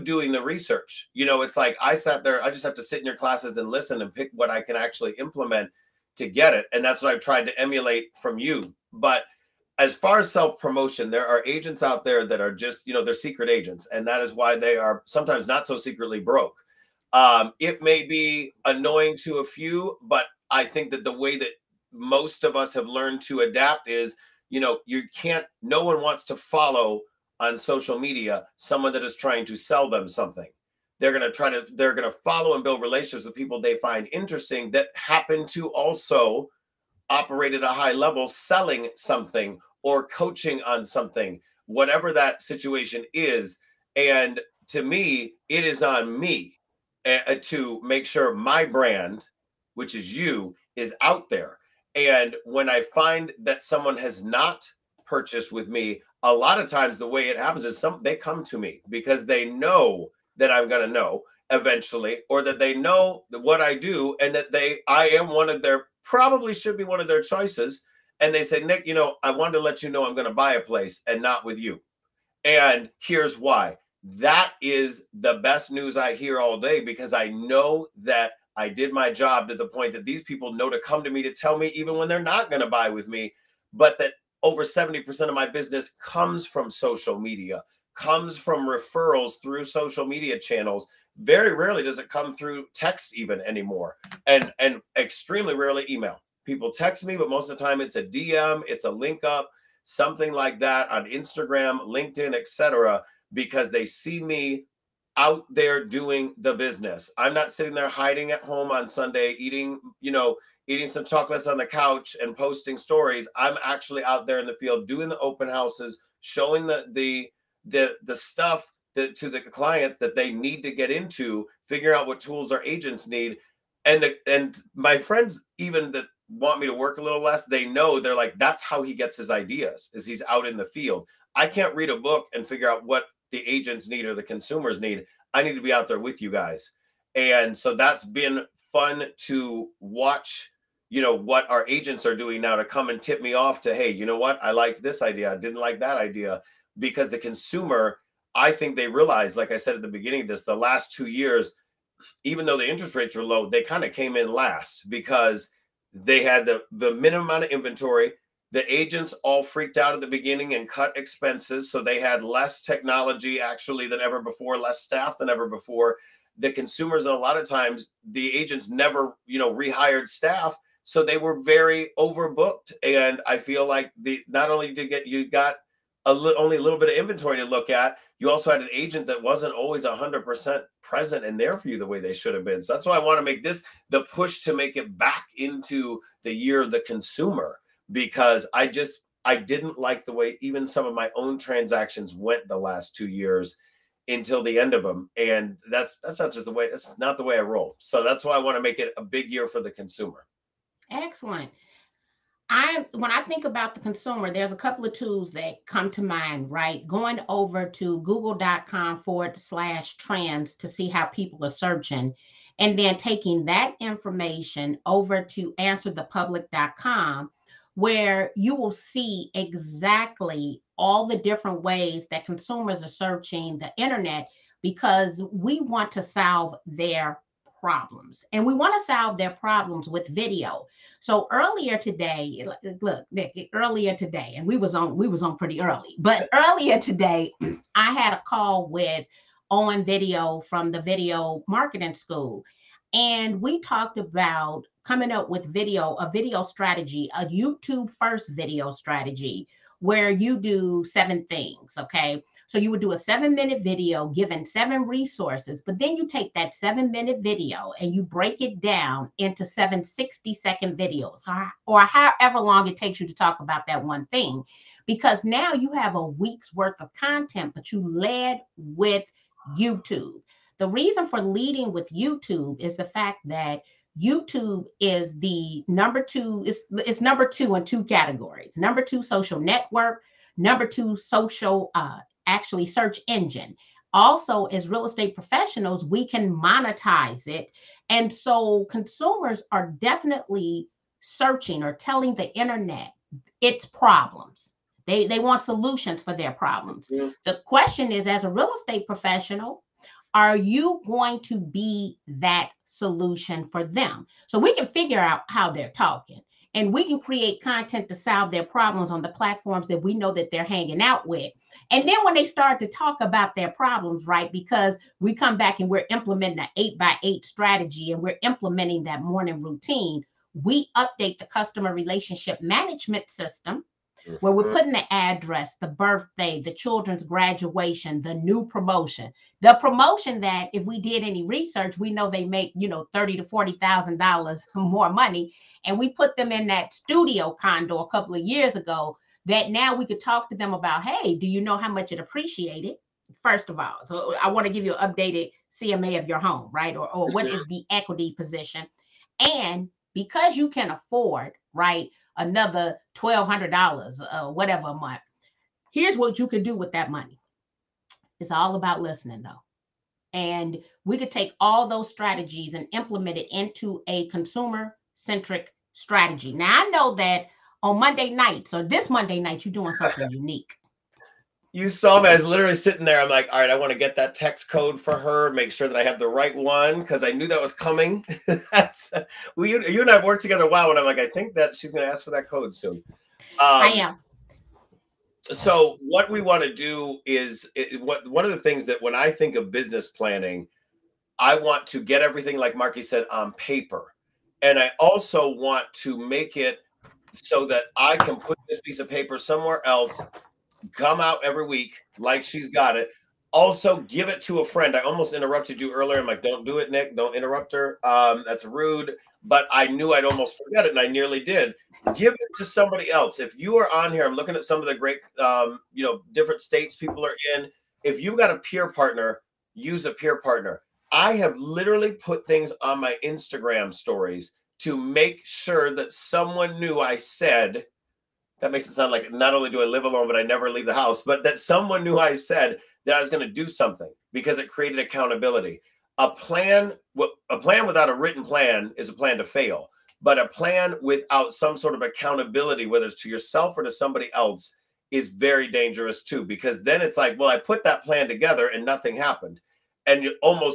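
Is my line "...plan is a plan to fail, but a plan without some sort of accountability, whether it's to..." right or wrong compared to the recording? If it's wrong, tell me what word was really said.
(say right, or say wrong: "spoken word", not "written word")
right.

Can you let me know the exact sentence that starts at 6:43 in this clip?
Also, give it to a friend.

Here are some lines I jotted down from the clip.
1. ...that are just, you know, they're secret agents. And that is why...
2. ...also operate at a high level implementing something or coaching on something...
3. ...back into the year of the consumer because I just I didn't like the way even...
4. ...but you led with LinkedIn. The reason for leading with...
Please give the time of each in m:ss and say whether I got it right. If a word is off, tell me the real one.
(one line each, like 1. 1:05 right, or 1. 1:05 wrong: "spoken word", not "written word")
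1. 0:12 right
2. 0:35 wrong: "selling", not "implementing"
3. 3:04 right
4. 4:27 wrong: "YouTube", not "LinkedIn".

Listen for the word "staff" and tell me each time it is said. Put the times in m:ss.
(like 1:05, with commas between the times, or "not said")
2:44, 2:50.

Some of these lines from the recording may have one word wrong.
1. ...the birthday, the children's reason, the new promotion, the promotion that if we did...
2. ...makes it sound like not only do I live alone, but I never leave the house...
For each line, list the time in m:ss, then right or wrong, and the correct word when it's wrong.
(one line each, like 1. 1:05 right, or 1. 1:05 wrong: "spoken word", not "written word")
1. 5:25 wrong: "graduation", not "reason"
2. 7:08 right.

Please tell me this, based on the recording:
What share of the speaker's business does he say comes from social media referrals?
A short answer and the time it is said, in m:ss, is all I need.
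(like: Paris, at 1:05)
over 70%, at 1:24.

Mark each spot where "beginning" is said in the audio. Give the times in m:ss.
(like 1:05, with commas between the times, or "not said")
2:29, 2:40.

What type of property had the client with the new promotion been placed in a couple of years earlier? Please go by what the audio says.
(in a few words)
studio condo.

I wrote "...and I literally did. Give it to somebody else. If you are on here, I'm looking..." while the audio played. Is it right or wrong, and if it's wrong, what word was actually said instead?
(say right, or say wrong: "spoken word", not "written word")
wrong: "nearly", not "literally".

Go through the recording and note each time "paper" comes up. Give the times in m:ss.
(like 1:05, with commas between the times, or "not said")
6:33, 6:38.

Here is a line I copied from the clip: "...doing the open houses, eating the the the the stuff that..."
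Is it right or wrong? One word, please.
wrong.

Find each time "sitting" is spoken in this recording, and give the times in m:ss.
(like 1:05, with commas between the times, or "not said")
1:47, 6:12.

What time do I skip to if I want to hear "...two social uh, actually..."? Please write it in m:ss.
4:40.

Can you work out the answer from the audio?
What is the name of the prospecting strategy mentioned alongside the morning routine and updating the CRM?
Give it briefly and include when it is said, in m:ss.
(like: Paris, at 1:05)
eight by eight, at 5:16.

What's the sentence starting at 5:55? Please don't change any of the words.
Here's what you can do with that money.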